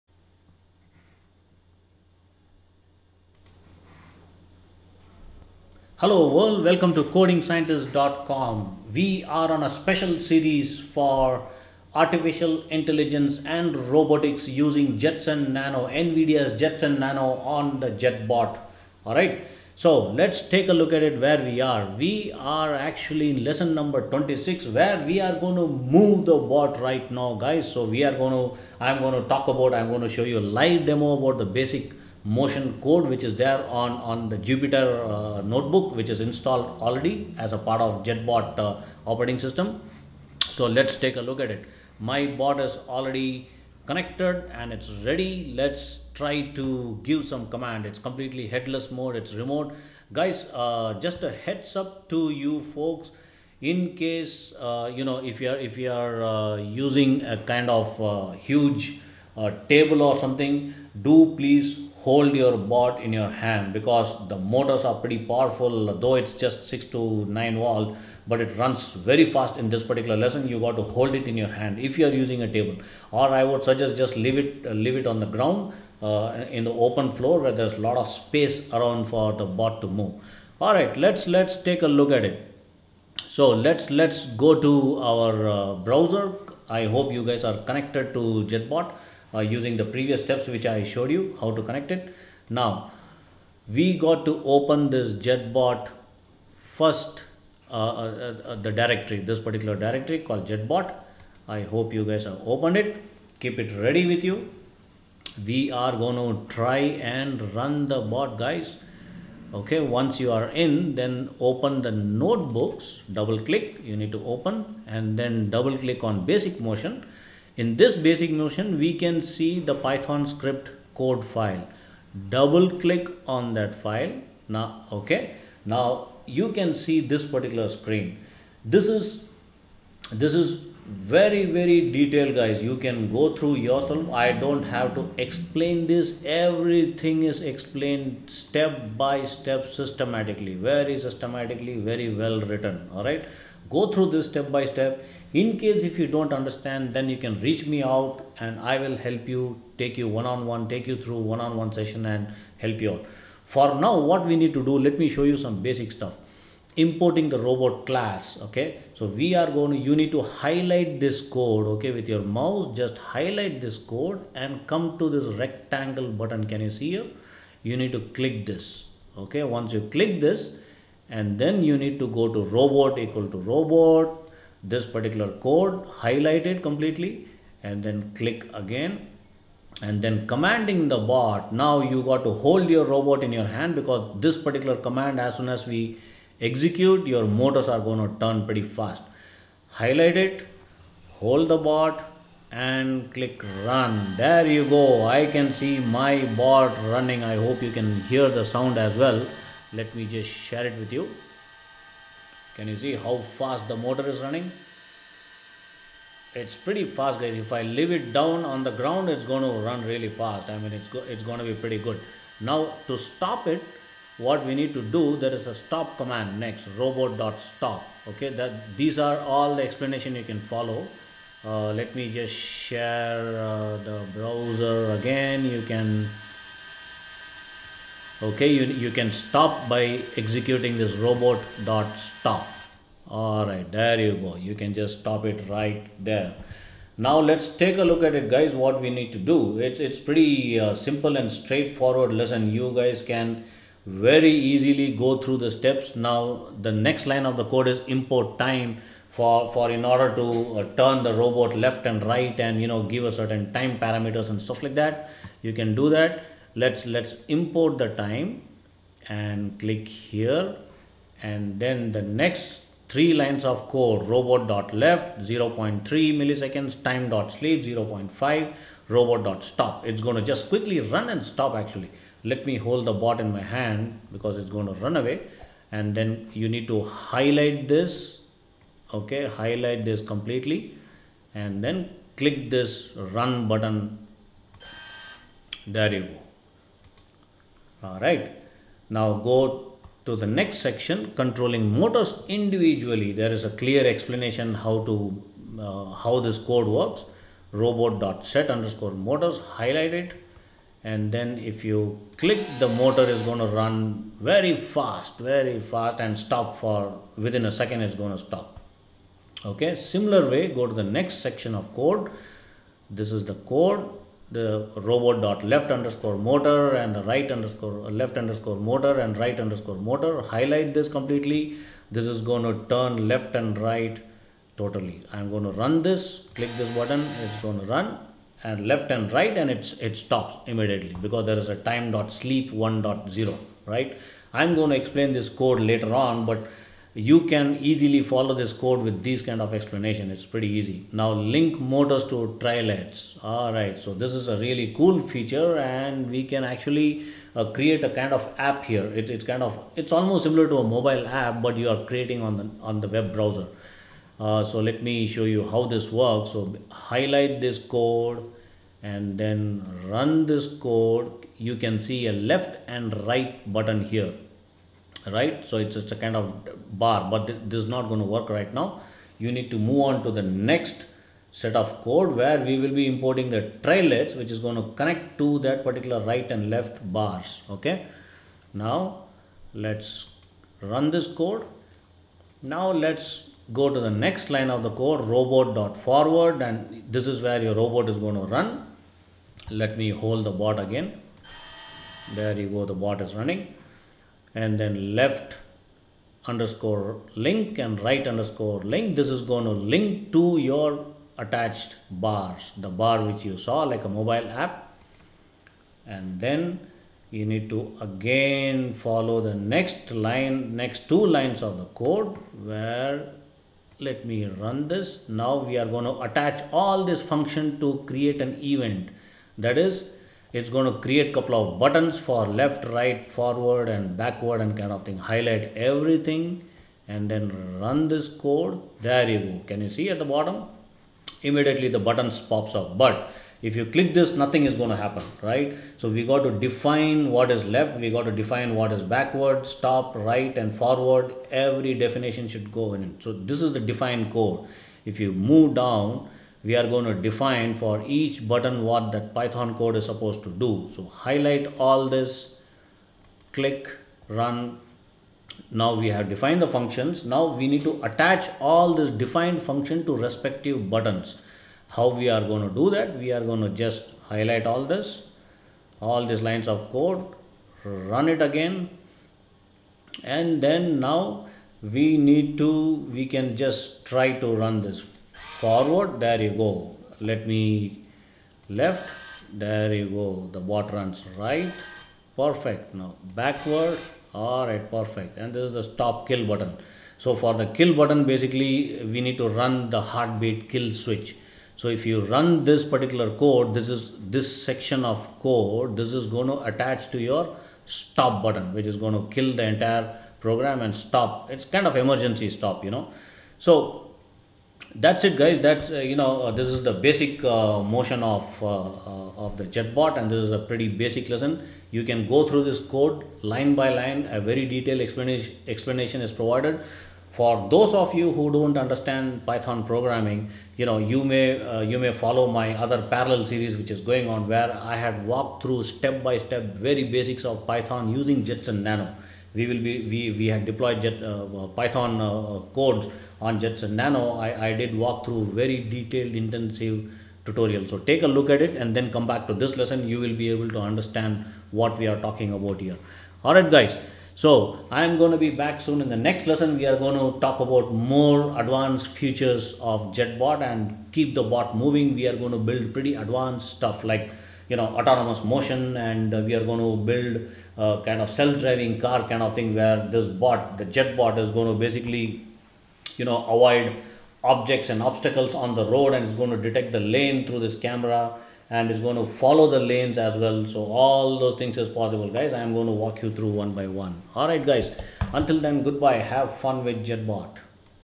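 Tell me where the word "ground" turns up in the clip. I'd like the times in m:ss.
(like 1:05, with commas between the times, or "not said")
1:15, 3:28.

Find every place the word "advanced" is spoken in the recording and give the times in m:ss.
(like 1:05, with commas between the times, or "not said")
9:08, 9:12.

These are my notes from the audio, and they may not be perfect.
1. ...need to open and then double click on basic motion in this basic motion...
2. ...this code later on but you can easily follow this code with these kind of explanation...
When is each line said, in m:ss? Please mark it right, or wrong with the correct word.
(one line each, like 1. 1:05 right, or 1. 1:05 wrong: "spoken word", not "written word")
1. 1:53 right
2. 5:35 right.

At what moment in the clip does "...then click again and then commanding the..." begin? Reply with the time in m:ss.
2:57.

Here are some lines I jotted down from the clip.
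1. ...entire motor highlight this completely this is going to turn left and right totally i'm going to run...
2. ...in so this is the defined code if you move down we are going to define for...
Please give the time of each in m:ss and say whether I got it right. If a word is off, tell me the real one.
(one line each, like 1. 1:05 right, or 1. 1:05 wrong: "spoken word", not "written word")
1. 5:19 wrong: "underscore", not "entire"
2. 7:22 right.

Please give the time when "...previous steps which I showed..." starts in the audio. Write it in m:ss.
1:29.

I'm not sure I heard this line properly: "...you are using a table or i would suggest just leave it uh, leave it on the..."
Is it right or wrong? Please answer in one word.
right.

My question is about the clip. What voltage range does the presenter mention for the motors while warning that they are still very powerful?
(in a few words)
6 to 9 volt.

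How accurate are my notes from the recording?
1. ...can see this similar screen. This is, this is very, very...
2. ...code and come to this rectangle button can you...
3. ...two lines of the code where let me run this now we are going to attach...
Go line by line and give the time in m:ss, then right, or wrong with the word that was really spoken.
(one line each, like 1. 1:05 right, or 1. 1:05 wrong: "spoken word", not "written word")
1. 2:06 wrong: "particular", not "similar"
2. 2:43 right
3. 6:50 right.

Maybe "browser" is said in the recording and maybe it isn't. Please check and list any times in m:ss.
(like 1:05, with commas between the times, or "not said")
1:25, 3:44, 5:53.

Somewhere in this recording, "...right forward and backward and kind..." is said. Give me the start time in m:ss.
7:02.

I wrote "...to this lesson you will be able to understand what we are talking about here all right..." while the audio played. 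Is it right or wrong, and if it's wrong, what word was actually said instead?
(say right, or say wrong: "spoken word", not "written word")
right.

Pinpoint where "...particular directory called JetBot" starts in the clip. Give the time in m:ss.
1:39.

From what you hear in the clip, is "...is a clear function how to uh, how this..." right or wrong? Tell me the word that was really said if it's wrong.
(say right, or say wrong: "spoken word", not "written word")
wrong: "explanation", not "function".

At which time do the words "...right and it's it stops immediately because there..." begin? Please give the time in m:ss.
5:29.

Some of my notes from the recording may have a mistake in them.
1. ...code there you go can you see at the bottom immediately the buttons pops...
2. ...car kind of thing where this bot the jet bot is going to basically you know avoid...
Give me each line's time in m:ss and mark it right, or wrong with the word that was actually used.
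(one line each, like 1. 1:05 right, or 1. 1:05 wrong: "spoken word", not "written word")
1. 7:08 right
2. 9:18 right.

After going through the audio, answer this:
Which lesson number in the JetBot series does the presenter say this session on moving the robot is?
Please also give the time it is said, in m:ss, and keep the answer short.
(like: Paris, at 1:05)
26, at 0:24.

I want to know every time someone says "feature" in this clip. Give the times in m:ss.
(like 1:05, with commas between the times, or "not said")
5:45, 9:08.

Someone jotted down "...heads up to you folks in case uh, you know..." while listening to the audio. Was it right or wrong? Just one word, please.
right.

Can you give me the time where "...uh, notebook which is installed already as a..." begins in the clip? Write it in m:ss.
0:35.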